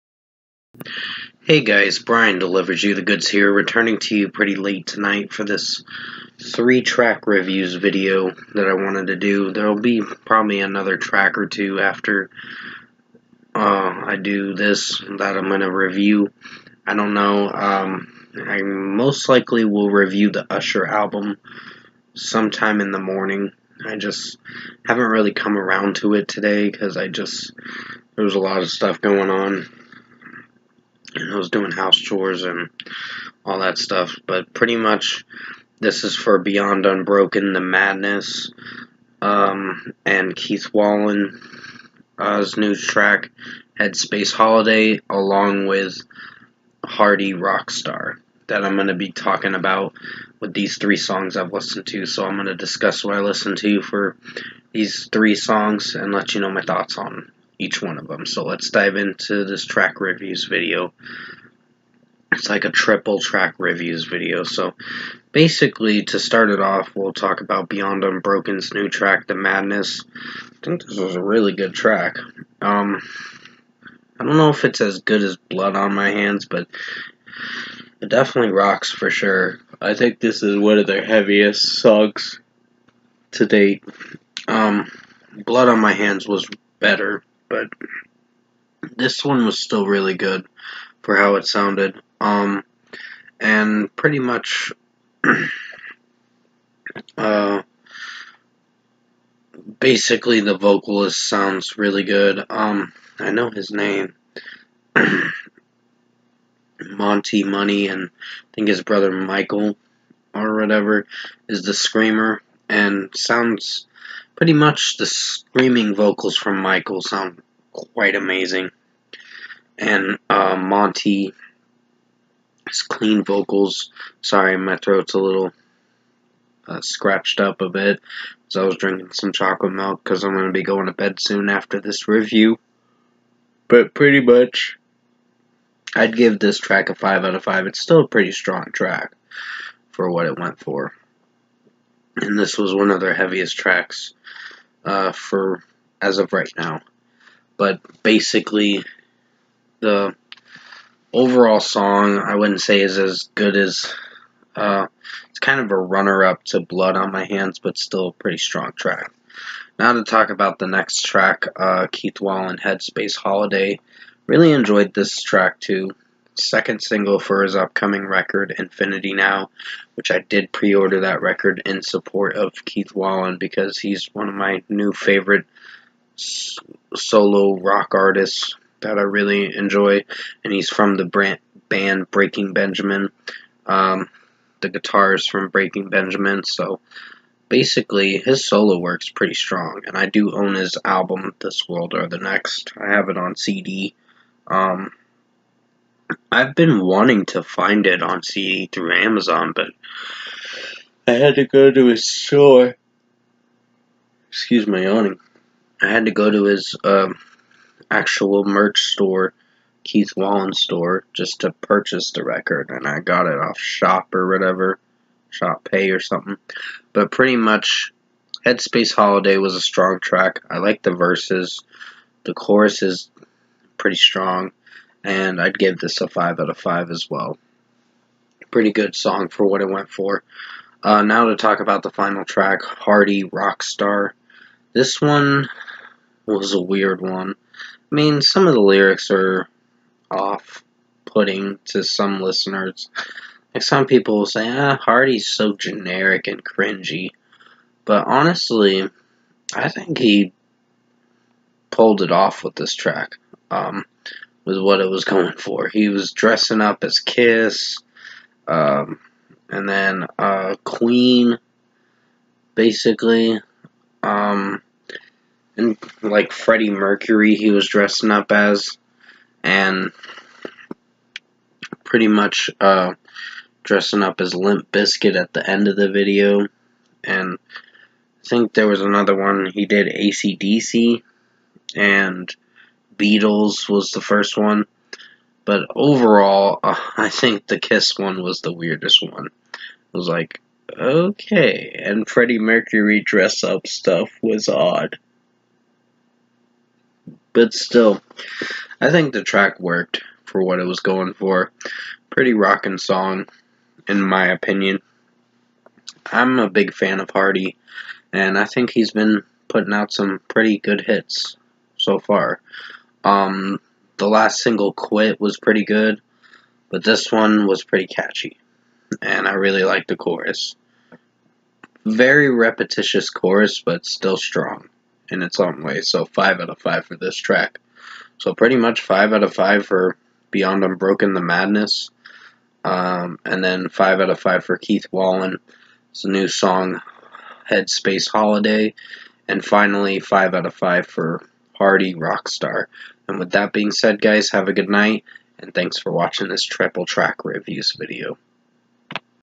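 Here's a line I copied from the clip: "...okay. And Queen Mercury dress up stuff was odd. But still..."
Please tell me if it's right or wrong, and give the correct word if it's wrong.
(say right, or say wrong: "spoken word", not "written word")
wrong: "Freddie", not "Queen".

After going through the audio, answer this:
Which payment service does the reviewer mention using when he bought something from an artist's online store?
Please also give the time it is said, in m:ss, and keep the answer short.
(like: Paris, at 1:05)
Shop Pay, at 3:35.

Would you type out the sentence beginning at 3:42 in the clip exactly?
The chorus is pretty strong and I'd give this a 5 out of 5 as well.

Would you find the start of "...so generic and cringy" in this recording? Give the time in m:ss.
4:05.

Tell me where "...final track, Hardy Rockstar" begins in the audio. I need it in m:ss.
3:51.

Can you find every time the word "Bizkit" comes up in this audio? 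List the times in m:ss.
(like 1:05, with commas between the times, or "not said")
4:34.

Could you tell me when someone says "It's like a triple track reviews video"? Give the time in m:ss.
1:02.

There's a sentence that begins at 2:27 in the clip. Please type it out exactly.
But basically, the overall song I wouldn't say is as good as.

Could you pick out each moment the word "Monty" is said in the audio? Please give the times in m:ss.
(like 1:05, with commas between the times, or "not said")
1:46, 2:00.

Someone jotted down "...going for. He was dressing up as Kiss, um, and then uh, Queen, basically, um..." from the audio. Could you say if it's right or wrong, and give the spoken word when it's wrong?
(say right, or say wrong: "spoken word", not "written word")
right.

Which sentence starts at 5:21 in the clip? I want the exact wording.
Very repetitious chorus, but still strong in its own way, so 5 out of 5 for this track.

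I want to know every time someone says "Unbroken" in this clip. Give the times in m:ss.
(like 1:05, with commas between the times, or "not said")
0:36, 1:08, 5:30.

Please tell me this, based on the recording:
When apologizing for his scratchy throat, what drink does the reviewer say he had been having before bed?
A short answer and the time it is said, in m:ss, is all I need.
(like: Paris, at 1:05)
chocolate milk, at 2:09.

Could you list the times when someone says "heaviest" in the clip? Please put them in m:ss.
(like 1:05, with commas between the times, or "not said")
1:21, 2:23.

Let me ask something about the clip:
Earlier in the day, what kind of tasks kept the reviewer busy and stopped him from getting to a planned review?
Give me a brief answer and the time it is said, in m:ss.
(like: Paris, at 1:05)
house chores, at 0:31.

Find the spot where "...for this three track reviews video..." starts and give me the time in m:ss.
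0:05.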